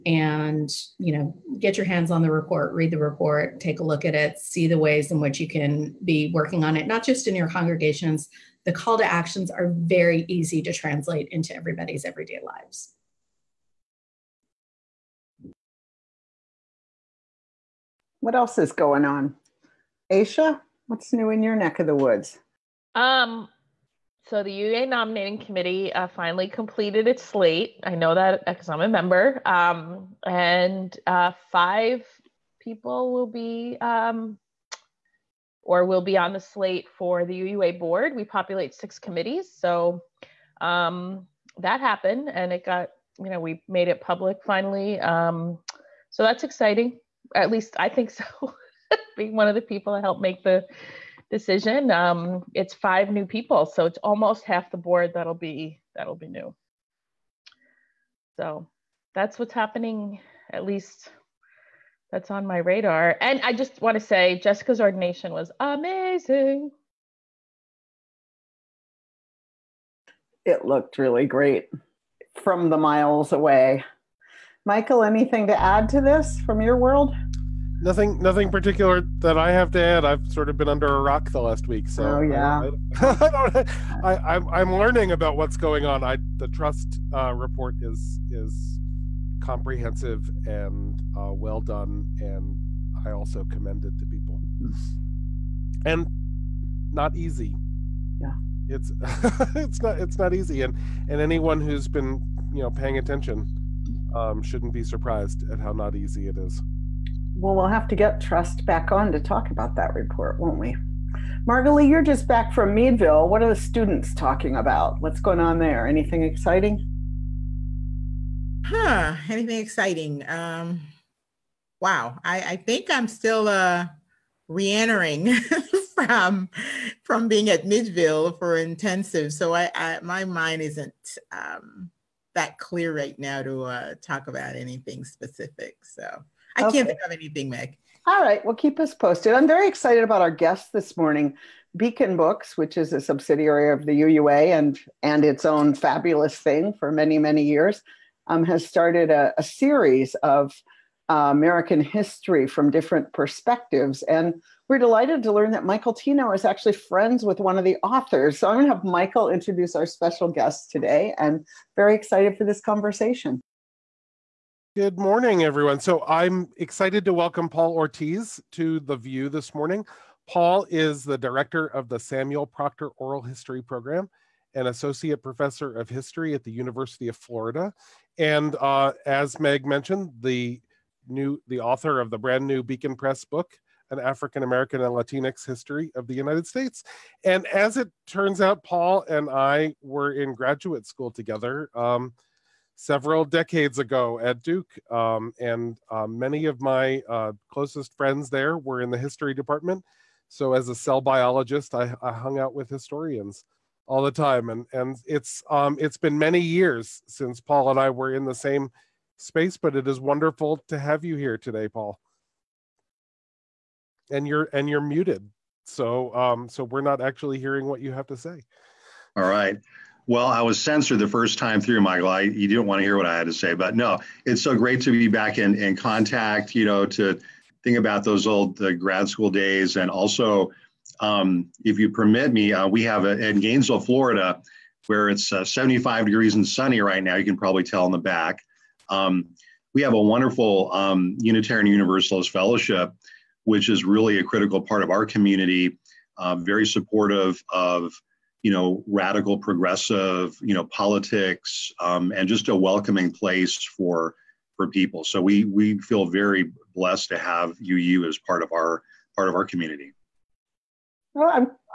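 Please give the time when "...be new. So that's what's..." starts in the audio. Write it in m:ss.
0:56.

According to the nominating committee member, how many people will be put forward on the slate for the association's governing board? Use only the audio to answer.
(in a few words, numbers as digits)
5.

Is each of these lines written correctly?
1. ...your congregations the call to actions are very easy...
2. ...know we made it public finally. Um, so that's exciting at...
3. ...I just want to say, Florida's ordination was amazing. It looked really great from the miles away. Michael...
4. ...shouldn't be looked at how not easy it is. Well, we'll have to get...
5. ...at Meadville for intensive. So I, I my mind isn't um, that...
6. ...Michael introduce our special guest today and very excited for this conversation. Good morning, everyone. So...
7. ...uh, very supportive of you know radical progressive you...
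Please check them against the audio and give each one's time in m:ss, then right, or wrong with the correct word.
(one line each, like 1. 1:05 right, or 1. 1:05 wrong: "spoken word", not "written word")
1. 0:07 right
2. 0:43 right
3. 1:03 wrong: "Jessica", not "Florida"
4. 1:44 wrong: "surprised", not "looked"
5. 2:07 right
6. 2:38 right
7. 4:06 right.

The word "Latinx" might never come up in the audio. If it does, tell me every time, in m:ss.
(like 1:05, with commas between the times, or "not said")
3:04.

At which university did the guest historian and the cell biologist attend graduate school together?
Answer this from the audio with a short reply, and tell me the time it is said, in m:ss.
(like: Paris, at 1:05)
Duke, at 3:14.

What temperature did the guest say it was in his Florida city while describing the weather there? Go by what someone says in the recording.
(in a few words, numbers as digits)
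75 degrees.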